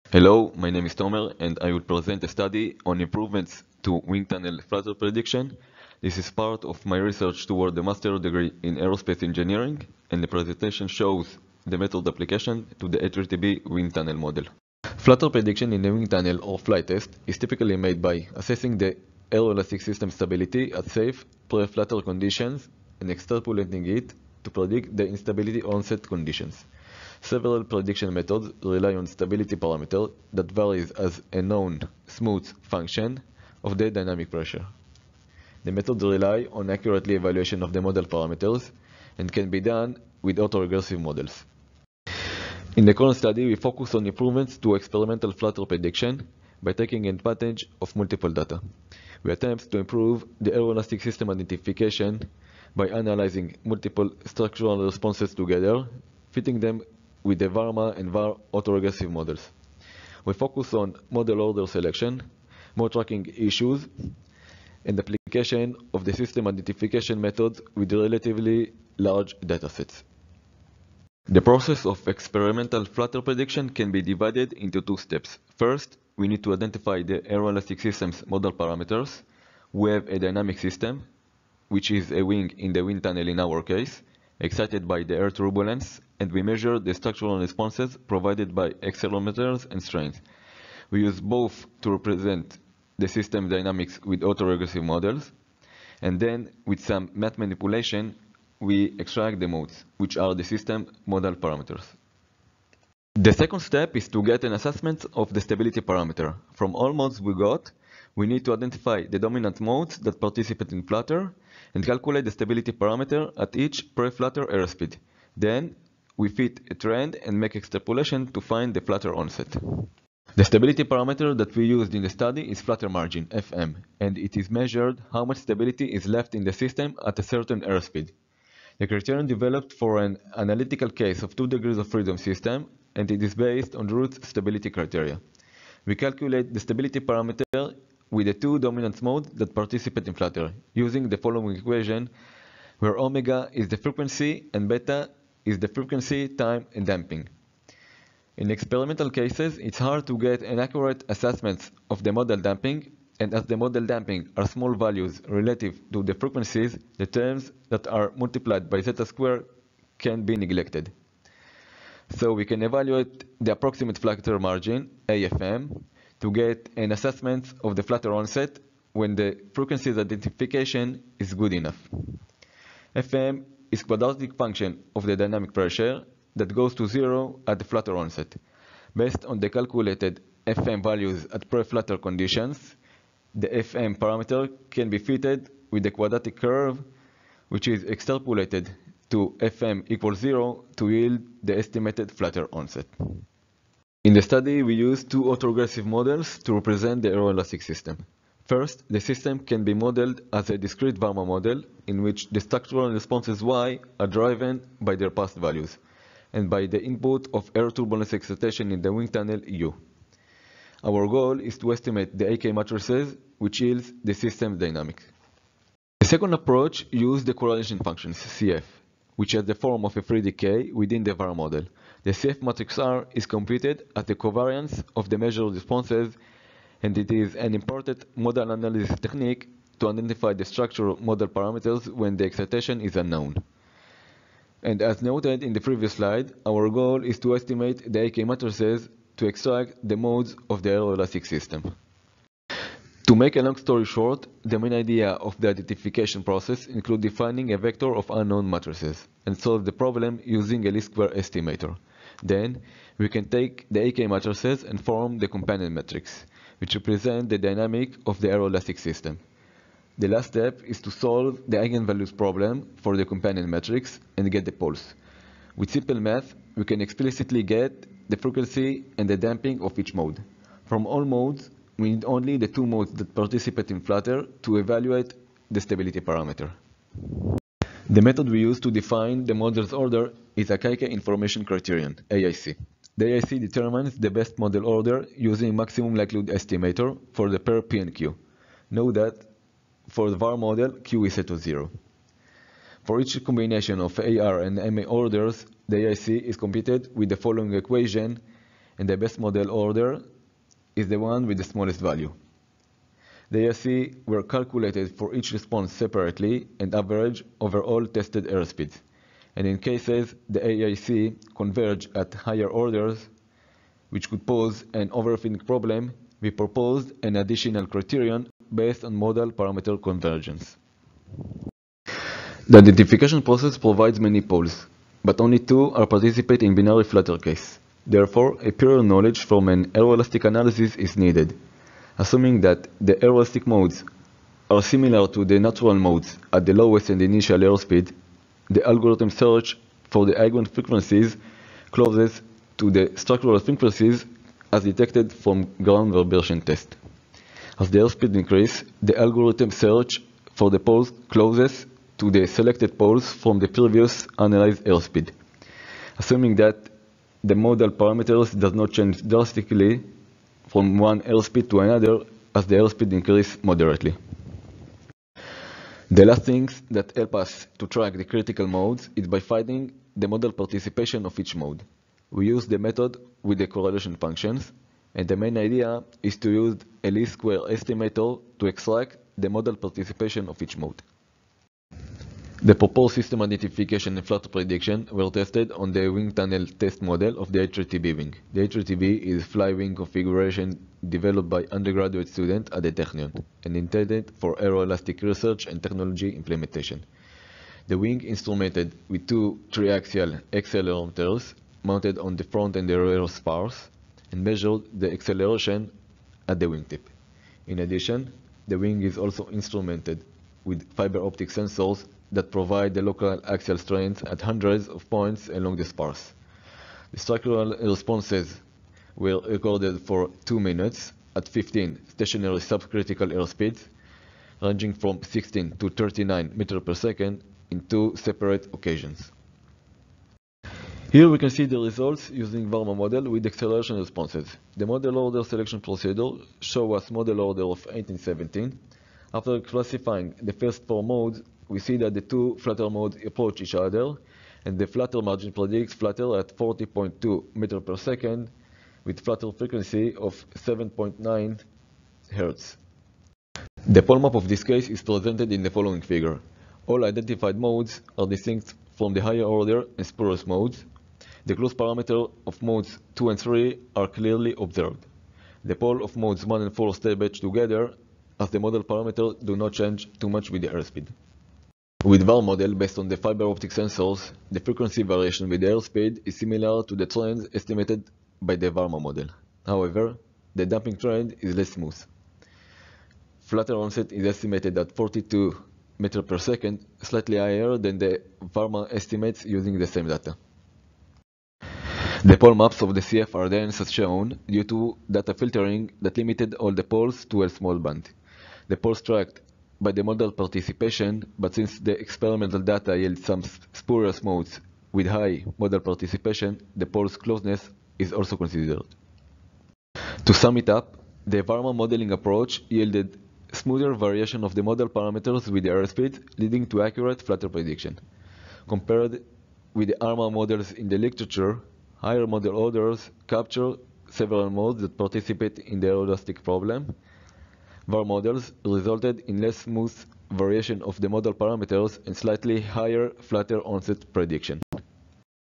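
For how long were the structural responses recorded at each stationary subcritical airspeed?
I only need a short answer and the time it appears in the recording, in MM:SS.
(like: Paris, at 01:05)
2 minutes, at 07:00.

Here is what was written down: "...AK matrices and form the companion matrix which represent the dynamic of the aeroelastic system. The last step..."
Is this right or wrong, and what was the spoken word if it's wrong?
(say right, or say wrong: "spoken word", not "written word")
right.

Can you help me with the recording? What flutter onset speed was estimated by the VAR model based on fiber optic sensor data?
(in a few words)
42 meters per second.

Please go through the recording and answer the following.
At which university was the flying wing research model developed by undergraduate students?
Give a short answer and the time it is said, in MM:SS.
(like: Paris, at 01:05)
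Technion, at 06:32.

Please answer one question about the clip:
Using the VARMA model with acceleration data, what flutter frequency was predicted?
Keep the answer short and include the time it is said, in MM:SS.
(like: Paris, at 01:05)
7.9 Hz, at 07:30.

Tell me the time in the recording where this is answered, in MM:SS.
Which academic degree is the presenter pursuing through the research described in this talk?
00:07.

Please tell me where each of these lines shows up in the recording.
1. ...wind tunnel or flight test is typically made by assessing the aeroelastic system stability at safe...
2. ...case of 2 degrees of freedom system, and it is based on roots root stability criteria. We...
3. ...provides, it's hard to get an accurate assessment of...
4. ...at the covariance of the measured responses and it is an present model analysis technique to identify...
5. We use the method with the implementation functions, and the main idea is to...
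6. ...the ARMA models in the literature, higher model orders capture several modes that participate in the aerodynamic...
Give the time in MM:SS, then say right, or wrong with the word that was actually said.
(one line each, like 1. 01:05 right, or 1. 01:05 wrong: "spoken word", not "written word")
1. 00:15 right
2. 02:11 right
3. 02:29 wrong: "cases", not "provides"
4. 03:43 wrong: "important", not "present"
5. 06:12 wrong: "correlation", not "implementation"
6. 08:39 right.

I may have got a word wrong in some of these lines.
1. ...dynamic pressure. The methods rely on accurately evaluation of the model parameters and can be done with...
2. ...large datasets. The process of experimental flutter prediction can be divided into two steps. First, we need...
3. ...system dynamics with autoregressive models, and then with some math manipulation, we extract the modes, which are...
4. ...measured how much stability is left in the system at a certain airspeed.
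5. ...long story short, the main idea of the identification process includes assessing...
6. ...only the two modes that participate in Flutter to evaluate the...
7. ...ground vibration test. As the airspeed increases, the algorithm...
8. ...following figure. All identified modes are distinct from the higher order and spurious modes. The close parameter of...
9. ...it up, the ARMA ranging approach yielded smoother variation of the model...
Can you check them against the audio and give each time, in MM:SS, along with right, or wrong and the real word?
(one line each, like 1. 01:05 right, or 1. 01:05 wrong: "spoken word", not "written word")
1. 00:33 right
2. 01:08 right
3. 01:33 right
4. 02:04 right
5. 04:03 wrong: "defining", not "assessing"
6. 04:32 right
7. 05:45 right
8. 07:35 right
9. 08:30 wrong: "modeling", not "ranging".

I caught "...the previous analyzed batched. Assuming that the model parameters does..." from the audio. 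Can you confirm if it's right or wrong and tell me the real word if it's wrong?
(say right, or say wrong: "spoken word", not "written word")
wrong: "airspeed", not "batched".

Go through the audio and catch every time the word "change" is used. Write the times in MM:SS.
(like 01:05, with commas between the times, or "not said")
05:58, 07:49.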